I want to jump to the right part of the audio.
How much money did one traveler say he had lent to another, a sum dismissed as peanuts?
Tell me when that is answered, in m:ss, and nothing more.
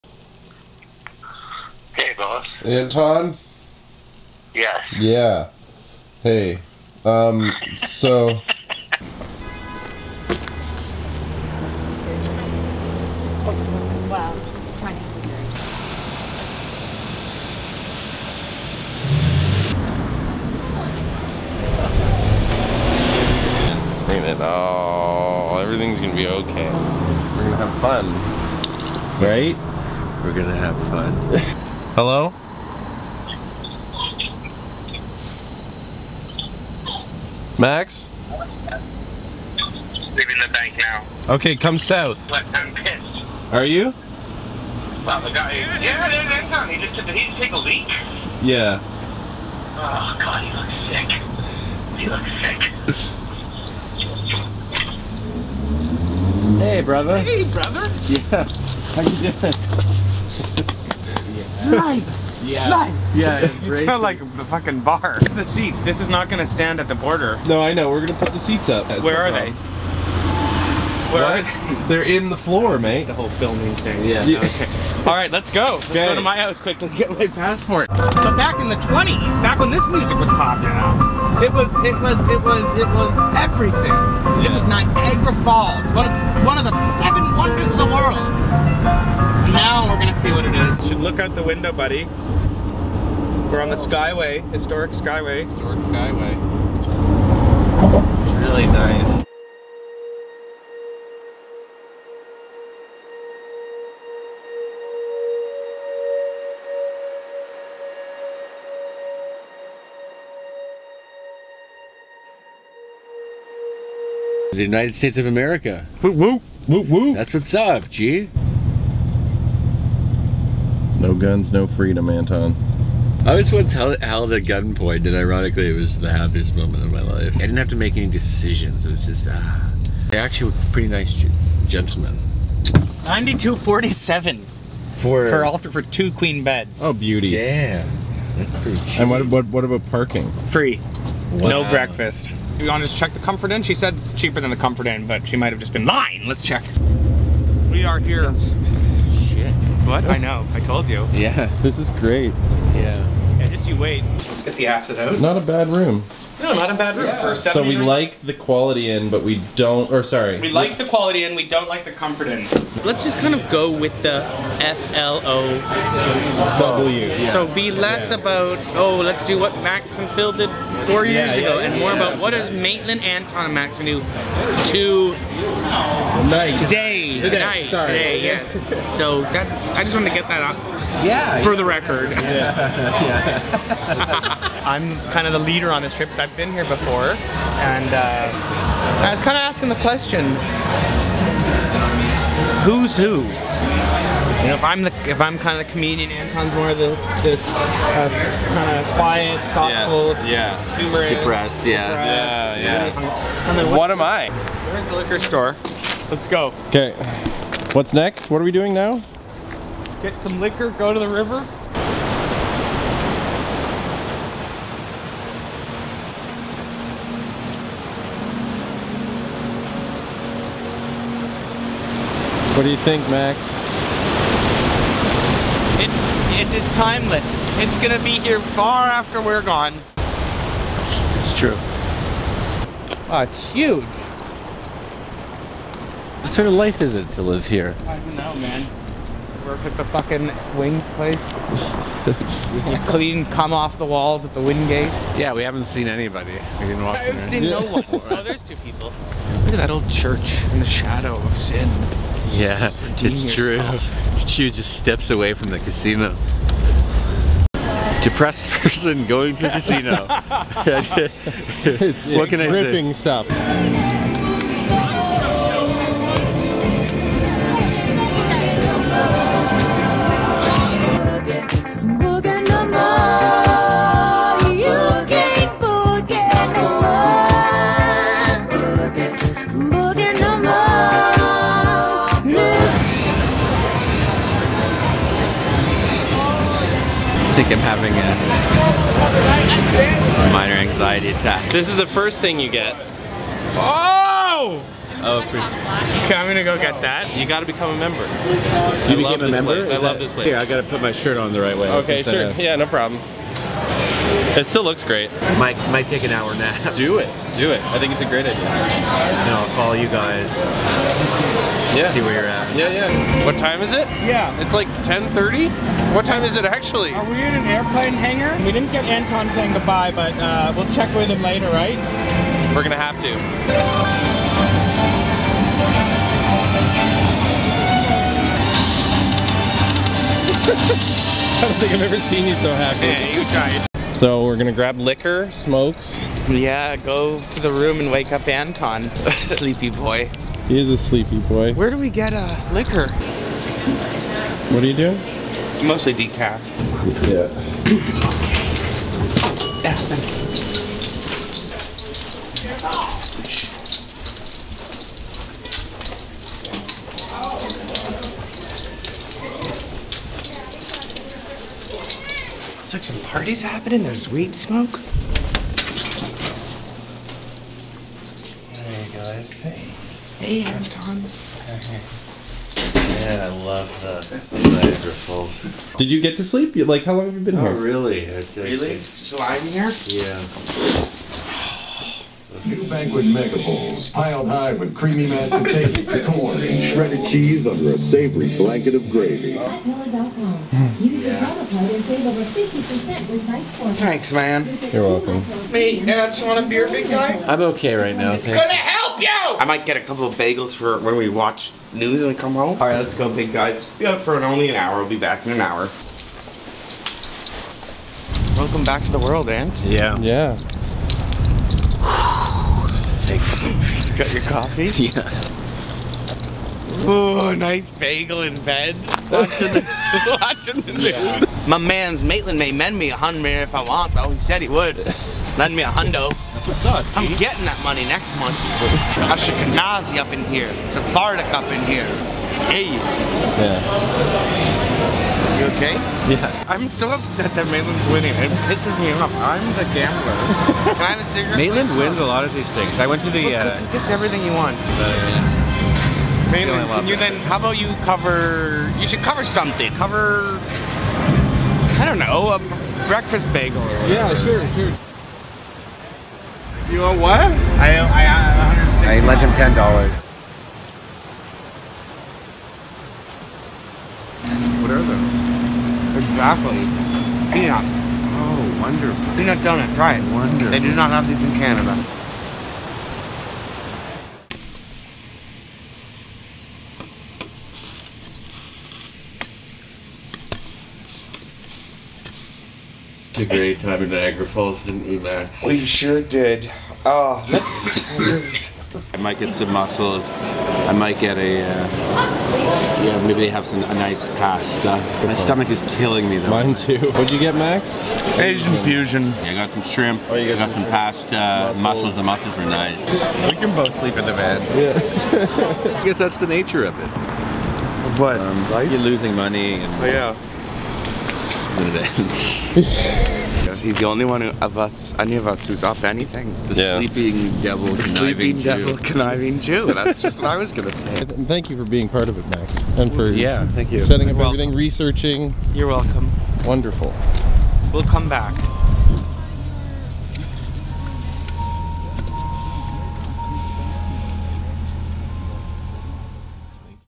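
7:39.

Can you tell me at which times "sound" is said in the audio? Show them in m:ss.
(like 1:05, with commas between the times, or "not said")
1:03.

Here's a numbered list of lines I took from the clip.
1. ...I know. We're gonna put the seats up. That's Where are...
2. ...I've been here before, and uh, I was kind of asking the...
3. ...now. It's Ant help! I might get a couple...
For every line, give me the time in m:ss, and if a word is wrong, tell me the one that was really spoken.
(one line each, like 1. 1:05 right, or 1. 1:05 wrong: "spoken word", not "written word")
1. 1:07 right
2. 3:06 right
3. 6:37 wrong: "Gonna", not "Ant".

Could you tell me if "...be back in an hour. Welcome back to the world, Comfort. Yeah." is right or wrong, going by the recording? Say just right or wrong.
wrong.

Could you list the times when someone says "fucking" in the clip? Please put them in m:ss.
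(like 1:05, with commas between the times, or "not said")
1:04, 3:59.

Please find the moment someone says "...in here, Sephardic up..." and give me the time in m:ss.
7:10.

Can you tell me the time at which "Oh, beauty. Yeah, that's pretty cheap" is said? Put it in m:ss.
2:16.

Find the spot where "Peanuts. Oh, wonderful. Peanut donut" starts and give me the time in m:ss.
7:47.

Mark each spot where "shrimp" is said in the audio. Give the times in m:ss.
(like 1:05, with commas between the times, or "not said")
8:19.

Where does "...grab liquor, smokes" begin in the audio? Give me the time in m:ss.
5:34.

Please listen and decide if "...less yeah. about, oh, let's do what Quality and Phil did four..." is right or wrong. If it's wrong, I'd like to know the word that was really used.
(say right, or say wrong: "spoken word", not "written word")
wrong: "Max", not "Quality".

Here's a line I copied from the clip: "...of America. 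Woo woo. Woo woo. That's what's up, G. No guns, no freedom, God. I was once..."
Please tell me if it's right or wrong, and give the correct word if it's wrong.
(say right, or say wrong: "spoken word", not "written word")
wrong: "Anton", not "God".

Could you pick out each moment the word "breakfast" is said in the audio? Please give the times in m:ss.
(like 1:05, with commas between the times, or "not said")
2:21, 7:32.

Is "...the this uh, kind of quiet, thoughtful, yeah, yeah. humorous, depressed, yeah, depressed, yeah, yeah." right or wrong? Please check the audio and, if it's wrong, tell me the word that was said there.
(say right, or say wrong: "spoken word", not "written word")
right.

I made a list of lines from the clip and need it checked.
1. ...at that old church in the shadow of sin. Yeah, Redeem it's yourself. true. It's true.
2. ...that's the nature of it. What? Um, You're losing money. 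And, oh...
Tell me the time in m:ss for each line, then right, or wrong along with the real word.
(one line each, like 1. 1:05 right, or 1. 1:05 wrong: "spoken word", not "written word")
1. 4:09 right
2. 8:25 right.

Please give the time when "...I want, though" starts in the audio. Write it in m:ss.
7:03.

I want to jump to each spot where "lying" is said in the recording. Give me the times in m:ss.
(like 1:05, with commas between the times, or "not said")
2:25, 6:19.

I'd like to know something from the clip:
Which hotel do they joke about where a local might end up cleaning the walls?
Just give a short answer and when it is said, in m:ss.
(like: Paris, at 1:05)
Wingate, at 4:04.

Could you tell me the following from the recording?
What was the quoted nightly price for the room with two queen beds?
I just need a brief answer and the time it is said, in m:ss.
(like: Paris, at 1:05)
$92.47, at 2:13.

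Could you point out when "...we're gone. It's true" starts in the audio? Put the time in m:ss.
3:49.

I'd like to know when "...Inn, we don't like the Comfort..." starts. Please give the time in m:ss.
2:41.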